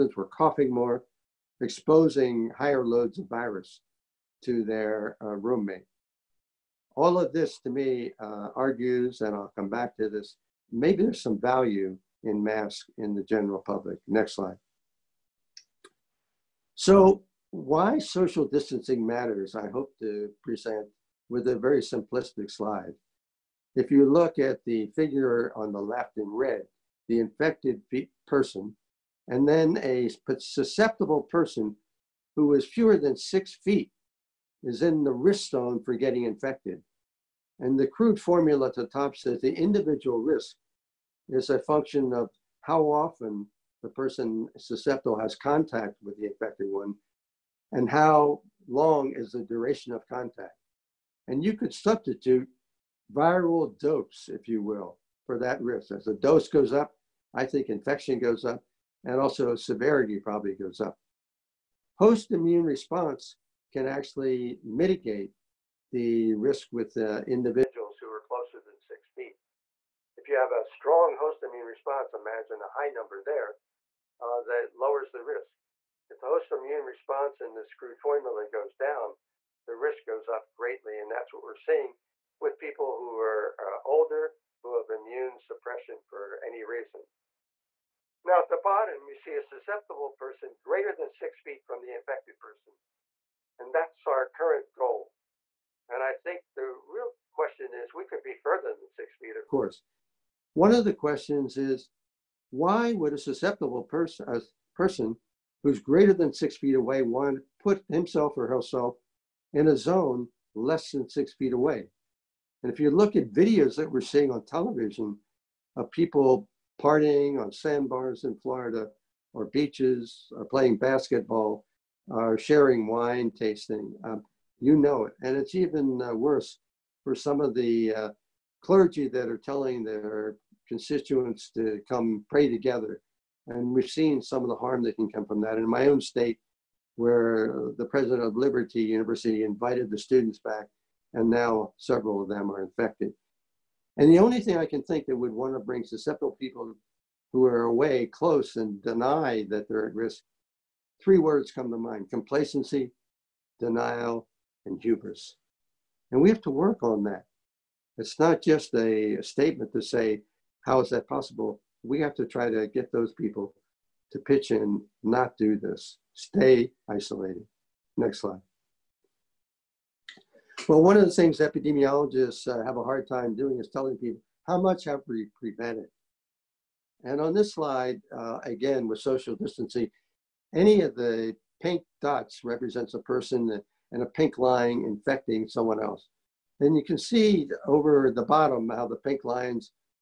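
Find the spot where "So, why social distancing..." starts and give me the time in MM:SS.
00:16.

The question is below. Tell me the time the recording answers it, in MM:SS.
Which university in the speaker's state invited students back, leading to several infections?
02:18.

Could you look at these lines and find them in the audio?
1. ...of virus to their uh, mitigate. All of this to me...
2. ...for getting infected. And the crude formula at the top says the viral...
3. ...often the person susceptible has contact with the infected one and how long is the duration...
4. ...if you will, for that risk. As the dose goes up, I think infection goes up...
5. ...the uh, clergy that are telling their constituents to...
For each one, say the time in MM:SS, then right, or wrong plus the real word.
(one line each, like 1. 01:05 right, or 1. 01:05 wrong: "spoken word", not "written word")
1. 00:03 wrong: "roommate", not "mitigate"
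2. 00:35 wrong: "individual", not "viral"
3. 00:42 right
4. 00:54 right
5. 02:07 right.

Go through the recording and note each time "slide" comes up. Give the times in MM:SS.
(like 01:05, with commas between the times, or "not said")
00:14, 00:22, 02:48, 02:57.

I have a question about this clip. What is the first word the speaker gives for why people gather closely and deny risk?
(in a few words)
complacency.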